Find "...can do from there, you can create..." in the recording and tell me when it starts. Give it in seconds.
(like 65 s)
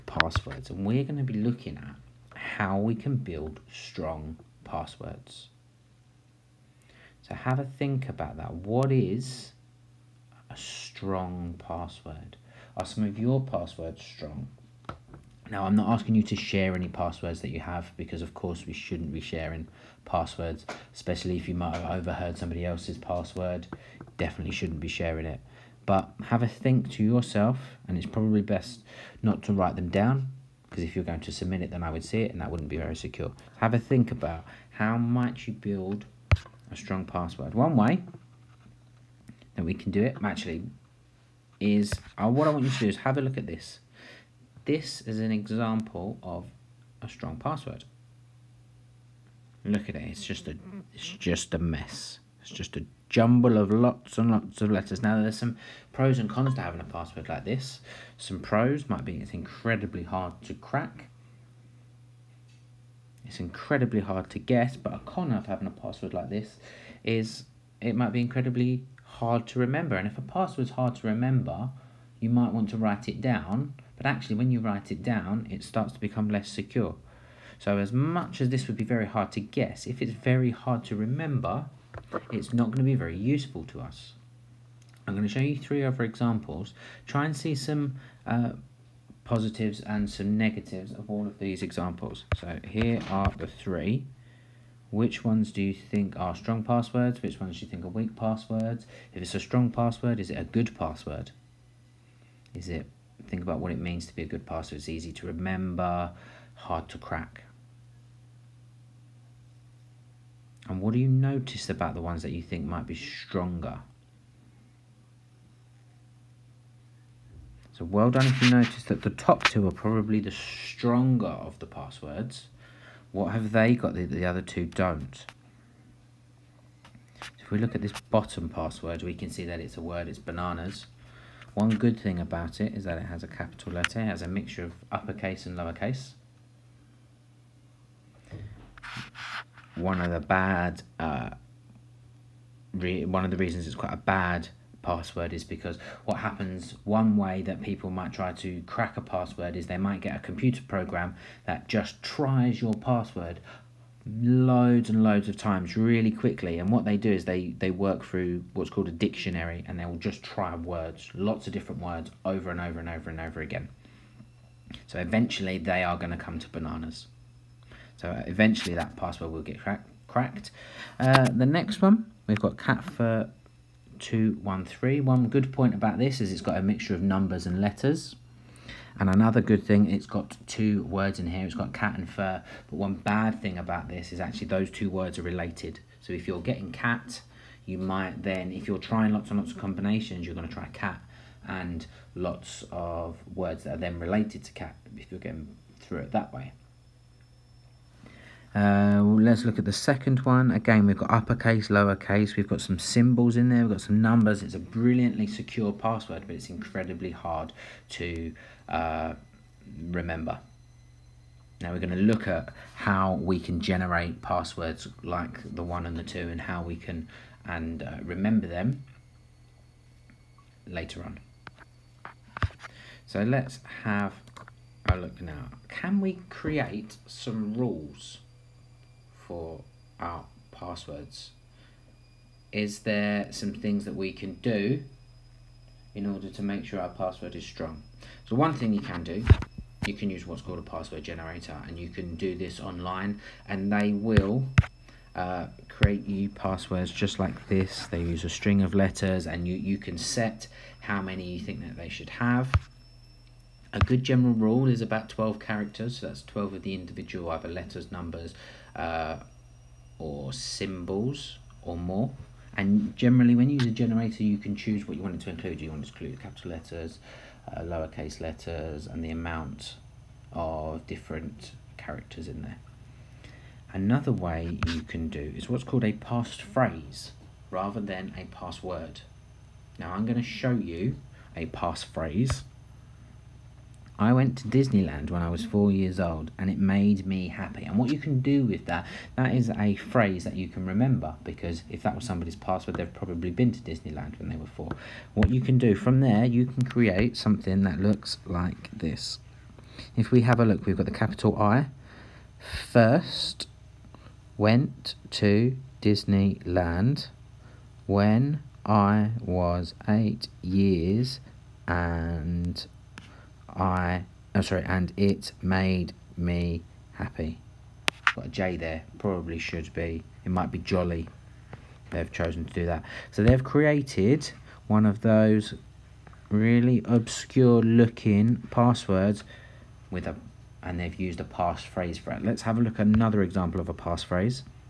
295 s.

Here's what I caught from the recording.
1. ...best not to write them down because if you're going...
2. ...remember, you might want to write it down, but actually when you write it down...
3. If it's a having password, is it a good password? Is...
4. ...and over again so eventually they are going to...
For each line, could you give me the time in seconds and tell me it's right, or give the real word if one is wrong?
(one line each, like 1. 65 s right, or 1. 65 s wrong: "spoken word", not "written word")
1. 28 s right
2. 71 s right
3. 99 s wrong: "strong", not "having"
4. 163 s right.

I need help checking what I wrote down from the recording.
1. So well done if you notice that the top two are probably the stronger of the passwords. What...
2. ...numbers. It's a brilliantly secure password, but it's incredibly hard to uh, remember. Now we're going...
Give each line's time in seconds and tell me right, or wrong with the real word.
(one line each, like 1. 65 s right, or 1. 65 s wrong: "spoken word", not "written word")
1. 117 s right
2. 204 s right.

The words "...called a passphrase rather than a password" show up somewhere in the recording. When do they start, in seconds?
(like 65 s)
275 s.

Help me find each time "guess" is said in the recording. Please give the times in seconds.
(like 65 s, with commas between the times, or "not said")
64 s, 79 s.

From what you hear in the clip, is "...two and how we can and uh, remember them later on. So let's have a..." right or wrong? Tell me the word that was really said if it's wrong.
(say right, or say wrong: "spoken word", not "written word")
right.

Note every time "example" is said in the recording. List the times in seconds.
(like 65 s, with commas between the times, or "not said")
45 s, 86 s, 91 s, 333 s.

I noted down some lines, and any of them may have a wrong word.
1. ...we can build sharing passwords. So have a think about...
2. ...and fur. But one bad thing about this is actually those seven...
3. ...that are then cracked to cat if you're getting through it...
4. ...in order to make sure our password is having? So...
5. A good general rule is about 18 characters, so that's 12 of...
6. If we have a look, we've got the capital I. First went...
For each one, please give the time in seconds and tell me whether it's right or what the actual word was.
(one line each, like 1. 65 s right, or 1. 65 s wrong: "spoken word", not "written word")
1. 2 s wrong: "strong", not "sharing"
2. 181 s wrong: "two", not "seven"
3. 193 s wrong: "related", not "cracked"
4. 235 s wrong: "strong", not "having"
5. 253 s wrong: "12", not "18"
6. 299 s right.